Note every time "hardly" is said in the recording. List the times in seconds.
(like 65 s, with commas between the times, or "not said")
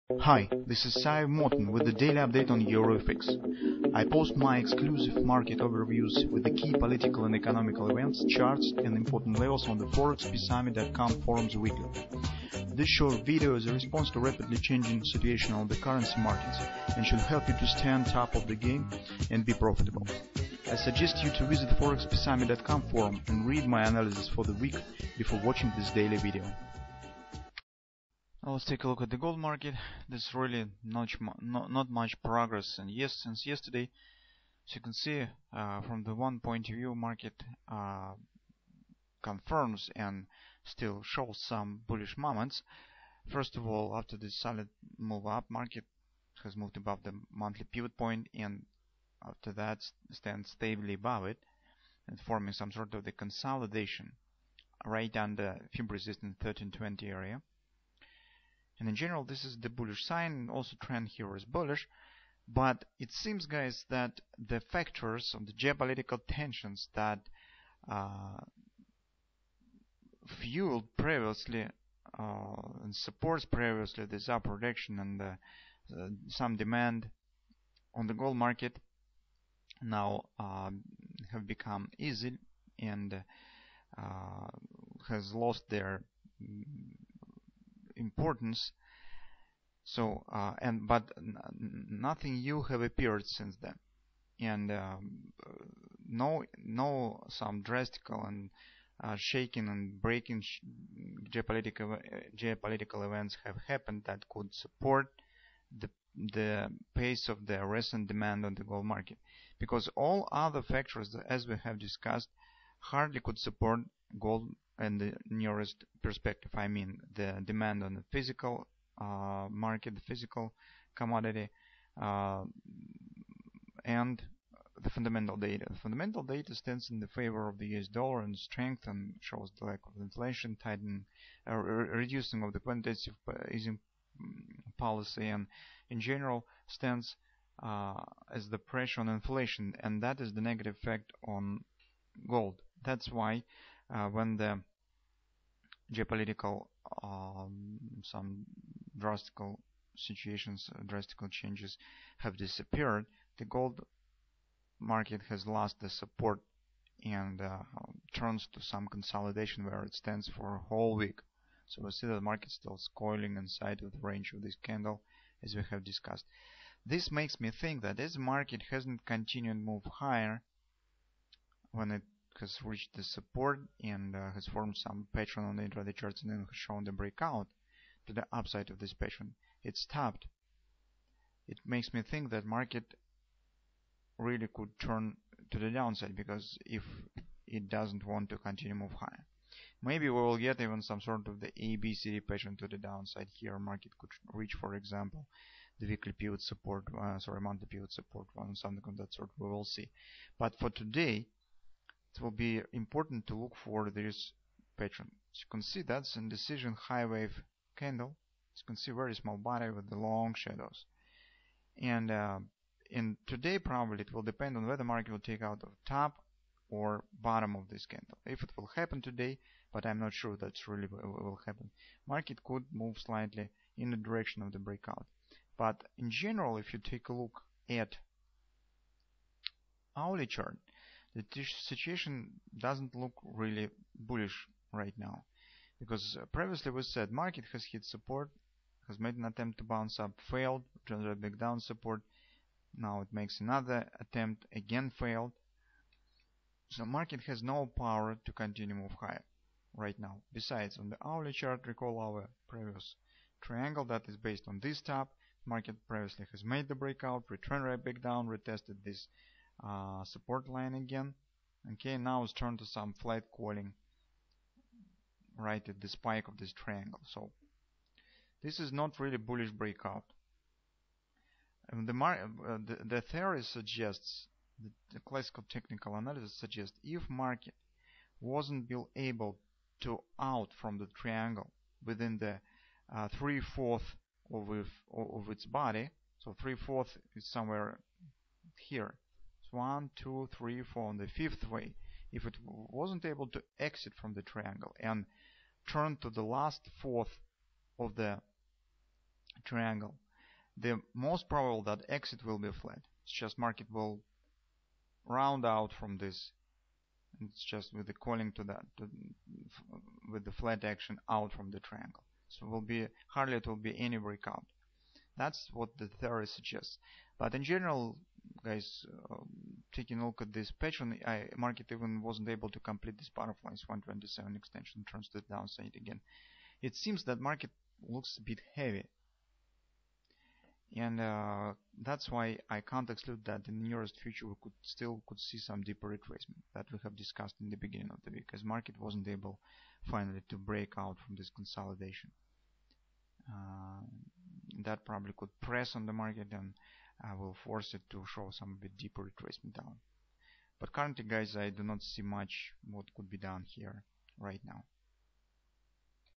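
112 s, 313 s.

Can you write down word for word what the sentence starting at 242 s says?
Now it makes another attempt, again failed.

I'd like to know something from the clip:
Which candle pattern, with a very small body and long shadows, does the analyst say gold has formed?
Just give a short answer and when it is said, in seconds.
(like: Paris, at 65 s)
high wave candle, at 206 s.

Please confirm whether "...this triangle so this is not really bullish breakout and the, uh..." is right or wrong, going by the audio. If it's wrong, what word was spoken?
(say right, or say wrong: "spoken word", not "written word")
right.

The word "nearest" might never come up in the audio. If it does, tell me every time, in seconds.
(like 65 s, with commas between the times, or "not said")
115 s, 333 s.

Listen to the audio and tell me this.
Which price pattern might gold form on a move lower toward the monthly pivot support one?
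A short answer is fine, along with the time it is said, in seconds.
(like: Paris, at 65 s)
ABCD pattern, at 191 s.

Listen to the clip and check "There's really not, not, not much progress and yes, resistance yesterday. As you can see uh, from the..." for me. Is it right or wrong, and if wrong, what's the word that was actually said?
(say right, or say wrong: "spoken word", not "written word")
wrong: "since", not "resistance".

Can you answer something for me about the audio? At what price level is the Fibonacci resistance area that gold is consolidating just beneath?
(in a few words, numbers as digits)
1320.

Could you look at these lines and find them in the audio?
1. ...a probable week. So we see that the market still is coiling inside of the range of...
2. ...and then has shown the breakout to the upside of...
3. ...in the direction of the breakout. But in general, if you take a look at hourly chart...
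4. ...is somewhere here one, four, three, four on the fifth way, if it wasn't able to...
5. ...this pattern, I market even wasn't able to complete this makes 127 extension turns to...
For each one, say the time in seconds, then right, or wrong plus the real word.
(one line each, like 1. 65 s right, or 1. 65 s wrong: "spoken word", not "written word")
1. 160 s wrong: "whole", not "probable"
2. 176 s right
3. 223 s right
4. 287 s wrong: "two", not "four"
5. 320 s wrong: "butterflies", not "makes".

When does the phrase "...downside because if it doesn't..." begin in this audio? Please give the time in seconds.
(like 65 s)
185 s.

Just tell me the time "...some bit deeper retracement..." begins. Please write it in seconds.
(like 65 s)
348 s.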